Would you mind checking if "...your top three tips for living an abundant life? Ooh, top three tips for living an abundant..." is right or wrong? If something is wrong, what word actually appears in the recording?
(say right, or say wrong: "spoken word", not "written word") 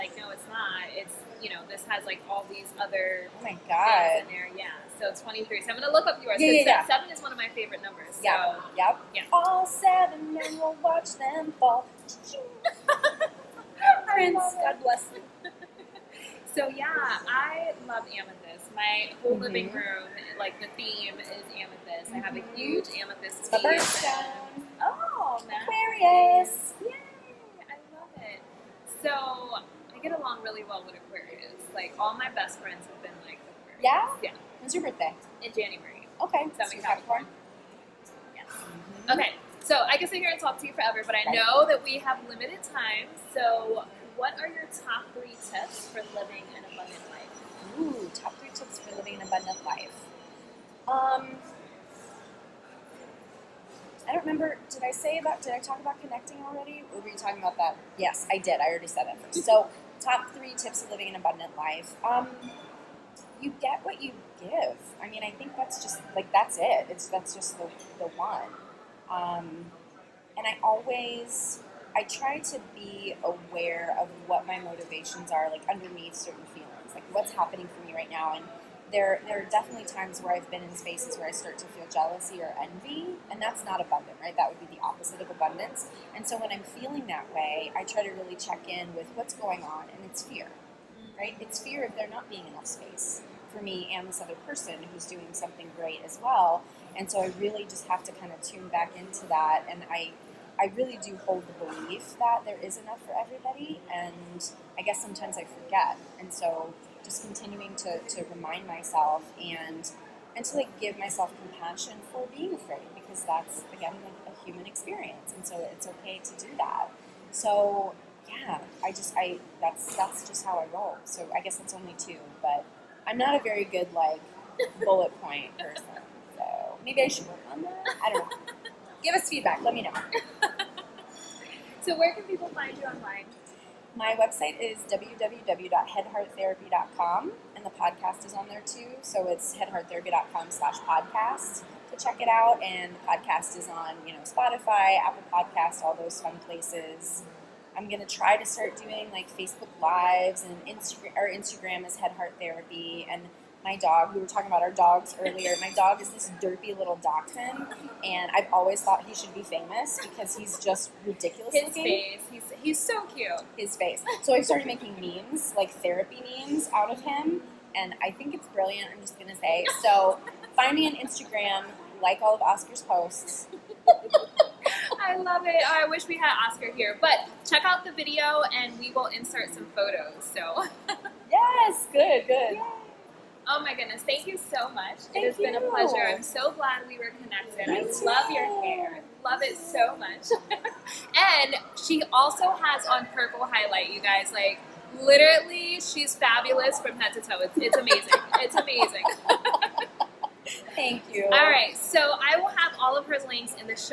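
right.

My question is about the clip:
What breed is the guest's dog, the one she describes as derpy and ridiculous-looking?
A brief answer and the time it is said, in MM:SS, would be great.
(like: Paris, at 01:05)
dachshund, at 02:37.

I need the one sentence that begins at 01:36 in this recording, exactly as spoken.
And so I really just have to kind of tune back into that, and I.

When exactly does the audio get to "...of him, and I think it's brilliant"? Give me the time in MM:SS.
02:46.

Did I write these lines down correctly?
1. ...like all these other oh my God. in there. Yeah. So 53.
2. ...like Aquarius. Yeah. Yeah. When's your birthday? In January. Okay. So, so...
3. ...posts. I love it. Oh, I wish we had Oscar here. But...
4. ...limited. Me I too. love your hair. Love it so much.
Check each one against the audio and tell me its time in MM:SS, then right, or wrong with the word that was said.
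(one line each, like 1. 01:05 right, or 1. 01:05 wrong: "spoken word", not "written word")
1. 00:02 wrong: "23", not "53"
2. 00:33 right
3. 02:52 right
4. 03:07 wrong: "connected", not "limited".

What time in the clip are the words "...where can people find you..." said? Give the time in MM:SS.
02:11.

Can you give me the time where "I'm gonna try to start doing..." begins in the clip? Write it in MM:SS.
02:27.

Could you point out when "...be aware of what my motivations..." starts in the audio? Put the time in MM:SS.
01:12.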